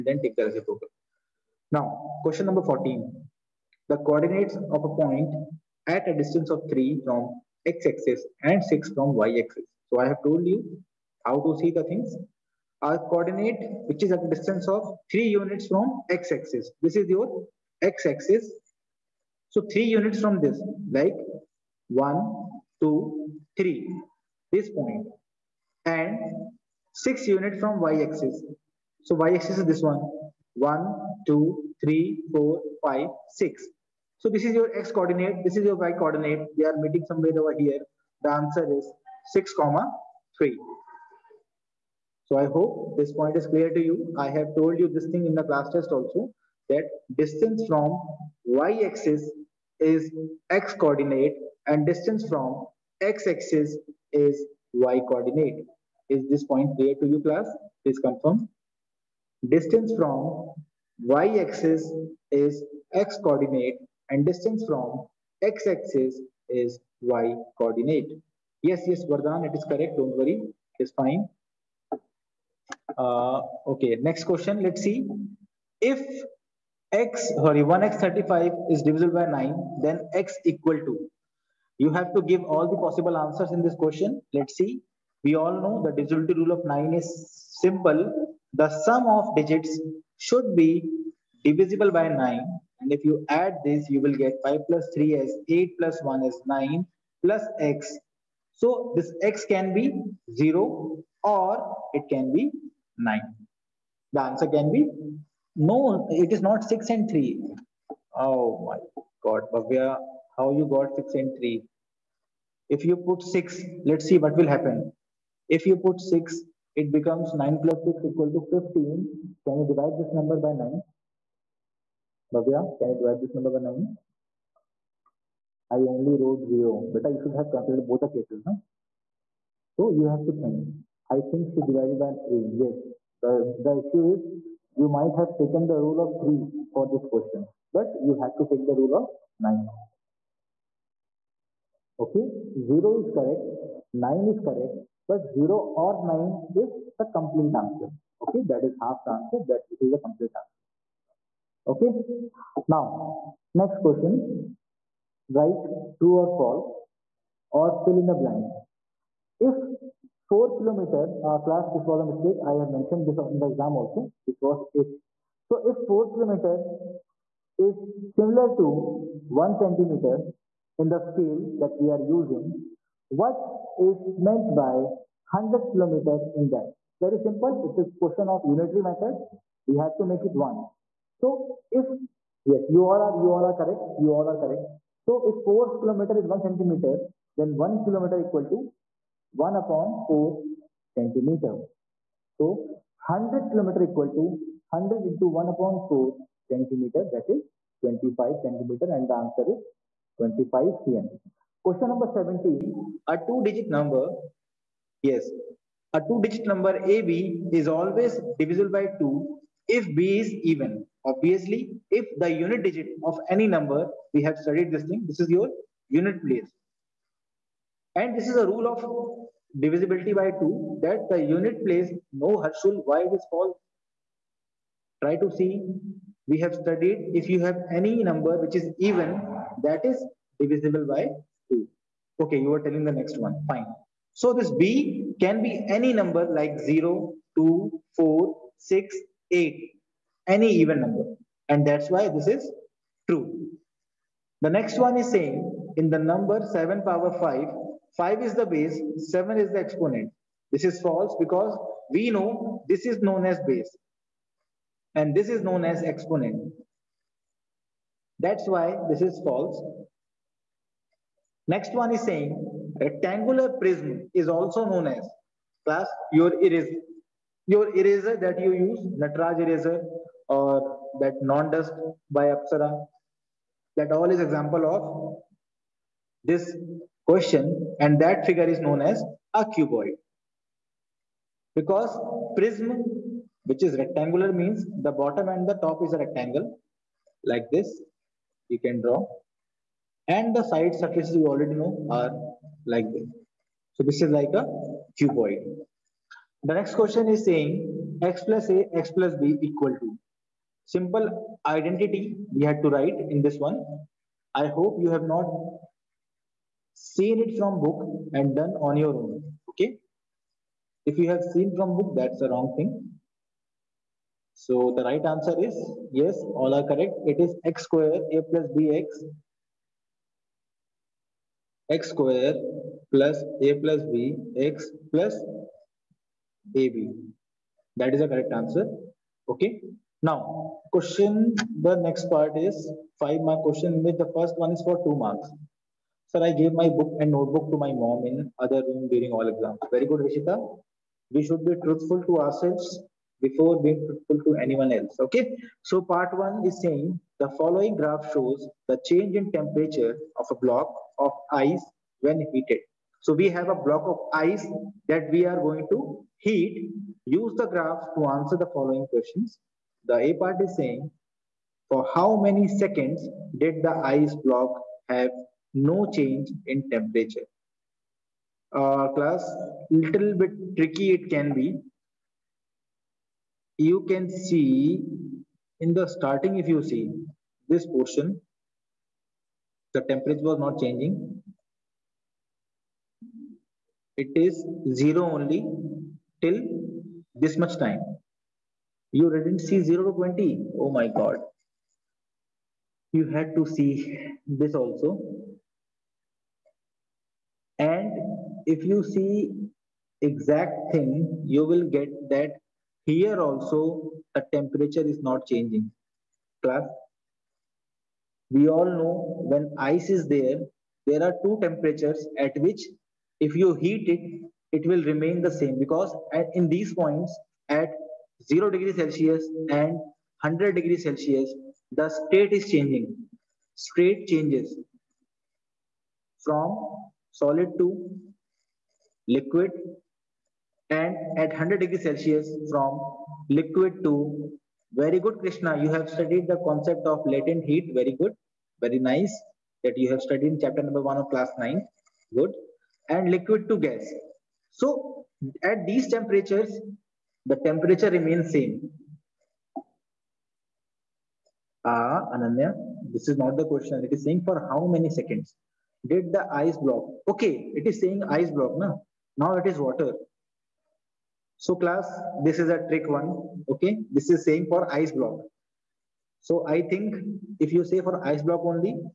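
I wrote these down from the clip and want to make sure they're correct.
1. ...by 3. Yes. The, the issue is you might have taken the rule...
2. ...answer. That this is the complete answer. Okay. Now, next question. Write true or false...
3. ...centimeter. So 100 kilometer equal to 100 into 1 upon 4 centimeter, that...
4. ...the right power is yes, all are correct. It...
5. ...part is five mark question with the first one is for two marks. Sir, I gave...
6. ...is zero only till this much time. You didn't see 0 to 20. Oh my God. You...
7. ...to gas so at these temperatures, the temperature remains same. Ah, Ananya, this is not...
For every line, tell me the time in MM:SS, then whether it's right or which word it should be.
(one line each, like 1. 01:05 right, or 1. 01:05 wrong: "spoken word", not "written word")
1. 02:11 right
2. 02:29 right
3. 03:10 right
4. 05:14 wrong: "answer", not "power"
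5. 05:32 right
6. 06:24 right
7. 07:23 right.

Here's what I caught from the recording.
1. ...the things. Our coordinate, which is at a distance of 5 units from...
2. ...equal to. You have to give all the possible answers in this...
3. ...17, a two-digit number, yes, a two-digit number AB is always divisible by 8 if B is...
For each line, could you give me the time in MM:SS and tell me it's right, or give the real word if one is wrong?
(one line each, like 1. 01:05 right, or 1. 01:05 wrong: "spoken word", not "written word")
1. 00:11 wrong: "3", not "5"
2. 01:20 right
3. 03:22 wrong: "2", not "8".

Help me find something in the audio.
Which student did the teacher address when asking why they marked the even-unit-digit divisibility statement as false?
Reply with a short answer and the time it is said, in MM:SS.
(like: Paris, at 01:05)
Harshul, at 03:42.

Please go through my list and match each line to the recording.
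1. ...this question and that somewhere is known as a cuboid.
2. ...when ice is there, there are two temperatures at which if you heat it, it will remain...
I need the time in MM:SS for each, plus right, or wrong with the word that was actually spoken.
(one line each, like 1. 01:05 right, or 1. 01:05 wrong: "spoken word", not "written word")
1. 04:36 wrong: "figure", not "somewhere"
2. 06:49 right.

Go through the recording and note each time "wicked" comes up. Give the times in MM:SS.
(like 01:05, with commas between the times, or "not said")
not said.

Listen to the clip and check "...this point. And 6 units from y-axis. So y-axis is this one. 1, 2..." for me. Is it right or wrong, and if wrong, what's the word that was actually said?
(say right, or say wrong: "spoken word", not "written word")
right.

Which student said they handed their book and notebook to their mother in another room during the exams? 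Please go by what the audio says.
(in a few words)
Rishita.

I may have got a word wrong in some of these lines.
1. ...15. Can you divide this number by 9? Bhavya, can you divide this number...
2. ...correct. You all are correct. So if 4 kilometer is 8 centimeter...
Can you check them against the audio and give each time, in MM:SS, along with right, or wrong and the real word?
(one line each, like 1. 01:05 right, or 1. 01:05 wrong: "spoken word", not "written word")
1. 01:58 right
2. 03:03 wrong: "1", not "8".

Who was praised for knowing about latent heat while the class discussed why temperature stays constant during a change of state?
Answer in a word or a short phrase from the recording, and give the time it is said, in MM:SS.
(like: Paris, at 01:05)
Krishna, at 07:15.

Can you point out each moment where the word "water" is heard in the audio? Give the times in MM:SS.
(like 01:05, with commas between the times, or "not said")
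07:39.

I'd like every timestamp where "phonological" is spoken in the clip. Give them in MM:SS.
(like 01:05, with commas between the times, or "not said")
not said.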